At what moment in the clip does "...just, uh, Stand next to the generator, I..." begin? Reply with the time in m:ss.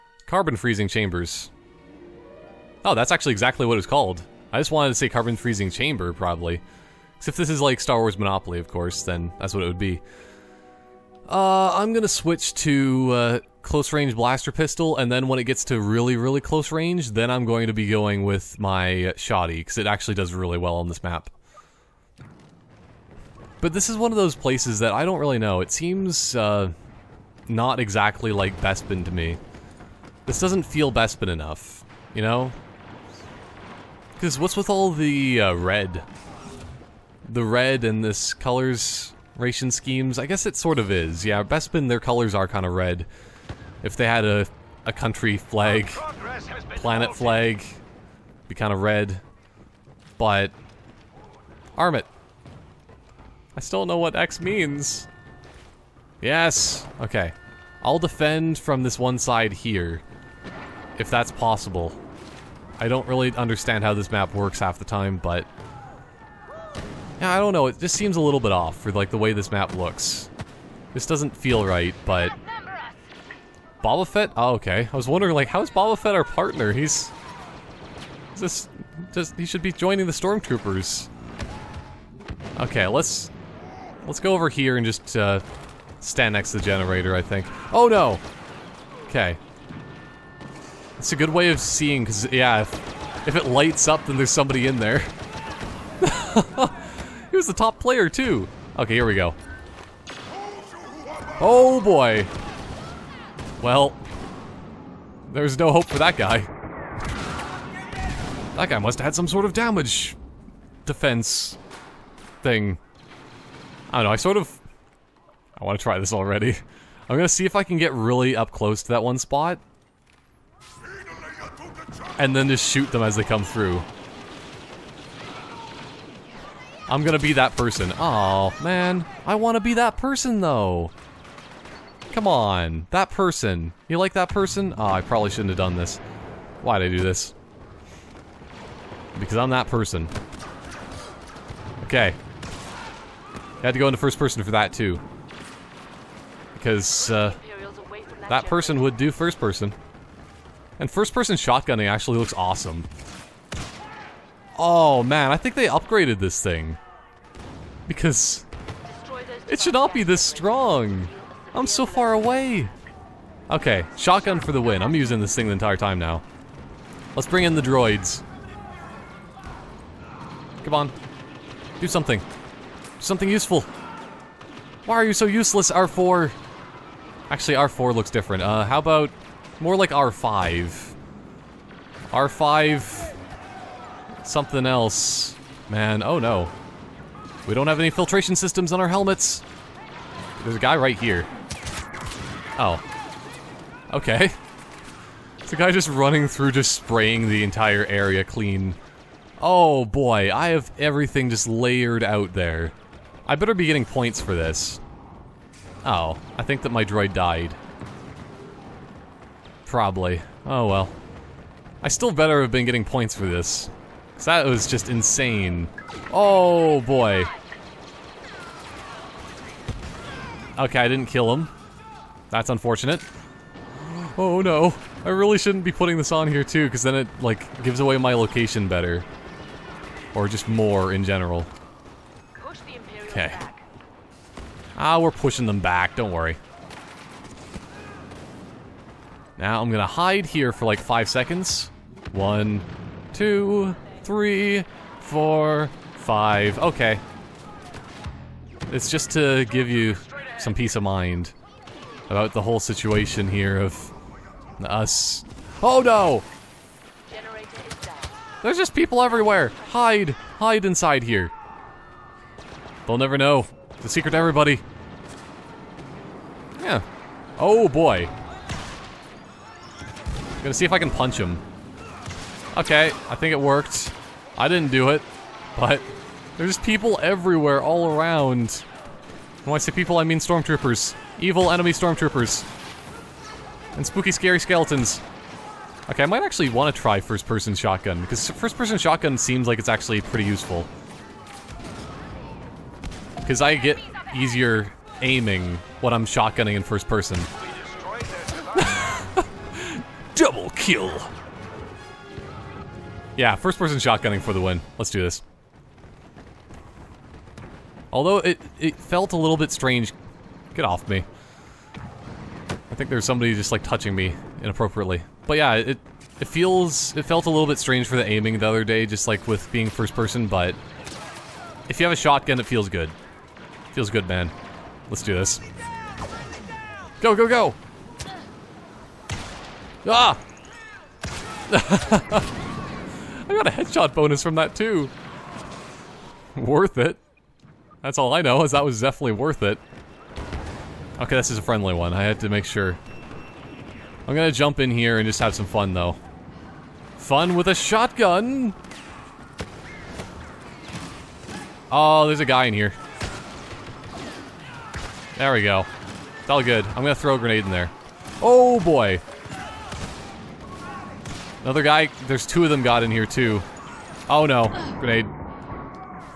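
1:24.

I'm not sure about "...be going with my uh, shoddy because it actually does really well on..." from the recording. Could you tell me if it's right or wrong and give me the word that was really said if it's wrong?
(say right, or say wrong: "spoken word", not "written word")
right.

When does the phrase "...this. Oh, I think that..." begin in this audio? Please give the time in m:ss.
3:24.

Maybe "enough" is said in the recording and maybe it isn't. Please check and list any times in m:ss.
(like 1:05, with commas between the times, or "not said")
0:31.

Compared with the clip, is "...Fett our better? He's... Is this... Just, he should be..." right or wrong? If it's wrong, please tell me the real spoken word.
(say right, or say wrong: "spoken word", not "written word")
wrong: "partner", not "better".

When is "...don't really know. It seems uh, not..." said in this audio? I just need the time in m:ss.
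0:25.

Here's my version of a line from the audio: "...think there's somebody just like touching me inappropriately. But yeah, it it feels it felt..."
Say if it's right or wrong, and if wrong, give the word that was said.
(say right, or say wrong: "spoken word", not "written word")
right.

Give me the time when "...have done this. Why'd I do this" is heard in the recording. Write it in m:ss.
2:15.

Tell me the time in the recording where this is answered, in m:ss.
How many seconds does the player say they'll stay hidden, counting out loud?
4:00.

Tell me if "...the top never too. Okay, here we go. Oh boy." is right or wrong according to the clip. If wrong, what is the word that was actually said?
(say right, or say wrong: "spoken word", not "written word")
wrong: "player", not "never".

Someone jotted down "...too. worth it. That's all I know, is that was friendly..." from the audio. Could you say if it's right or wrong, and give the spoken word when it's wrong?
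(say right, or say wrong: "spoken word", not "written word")
wrong: "definitely", not "friendly".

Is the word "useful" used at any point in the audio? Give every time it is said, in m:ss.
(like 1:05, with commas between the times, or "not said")
2:53, 4:50.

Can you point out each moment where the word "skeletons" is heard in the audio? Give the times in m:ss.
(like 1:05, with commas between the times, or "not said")
4:44.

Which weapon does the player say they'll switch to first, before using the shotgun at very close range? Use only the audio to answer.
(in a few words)
blaster pistol.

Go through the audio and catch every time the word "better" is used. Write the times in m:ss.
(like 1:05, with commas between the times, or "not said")
3:23, 3:32, 3:48.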